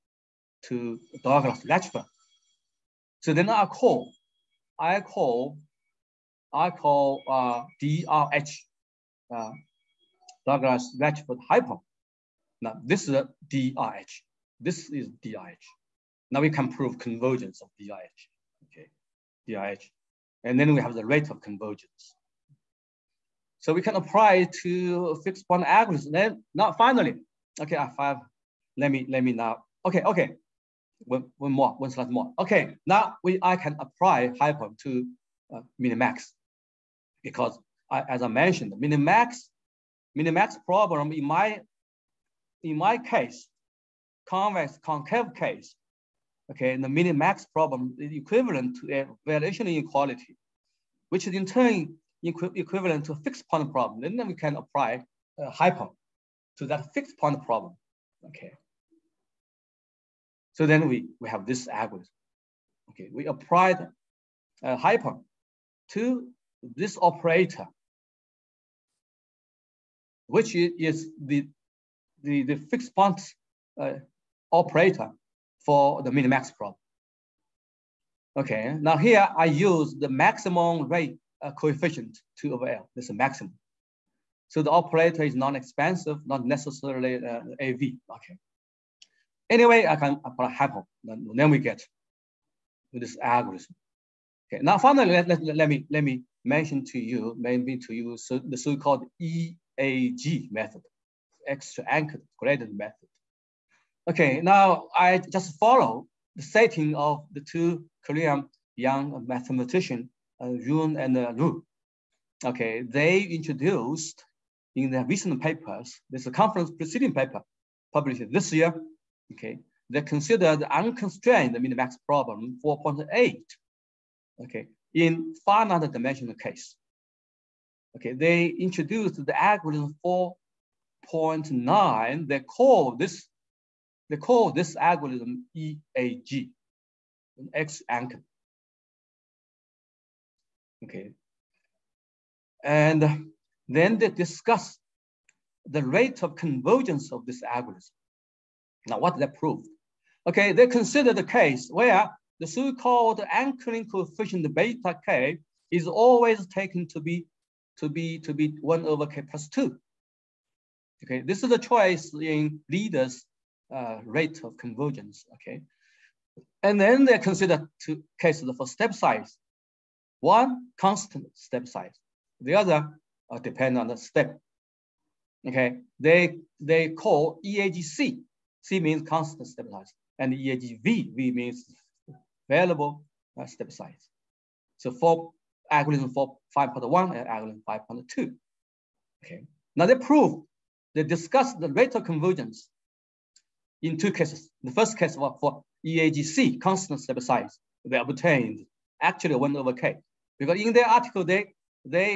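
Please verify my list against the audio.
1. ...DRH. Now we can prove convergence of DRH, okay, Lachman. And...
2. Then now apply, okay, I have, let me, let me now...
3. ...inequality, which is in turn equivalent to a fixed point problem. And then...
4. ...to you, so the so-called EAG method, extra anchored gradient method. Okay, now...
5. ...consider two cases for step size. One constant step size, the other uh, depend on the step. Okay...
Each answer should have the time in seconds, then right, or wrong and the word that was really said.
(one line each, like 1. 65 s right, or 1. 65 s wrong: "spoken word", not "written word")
1. 15 s wrong: "DRH", not "Lachman"
2. 26 s wrong: "finally", not "apply"
3. 49 s right
4. 97 s right
5. 167 s right.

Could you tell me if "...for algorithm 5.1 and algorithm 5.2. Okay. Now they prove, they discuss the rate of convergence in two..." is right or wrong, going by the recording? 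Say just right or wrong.
right.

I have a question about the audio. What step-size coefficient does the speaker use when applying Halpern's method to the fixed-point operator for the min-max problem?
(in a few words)
2/L.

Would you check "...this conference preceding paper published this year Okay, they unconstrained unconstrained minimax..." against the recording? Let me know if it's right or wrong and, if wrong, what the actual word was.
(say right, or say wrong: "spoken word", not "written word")
wrong: "considered", not "unconstrained".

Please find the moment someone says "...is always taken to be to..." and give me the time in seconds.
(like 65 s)
155 s.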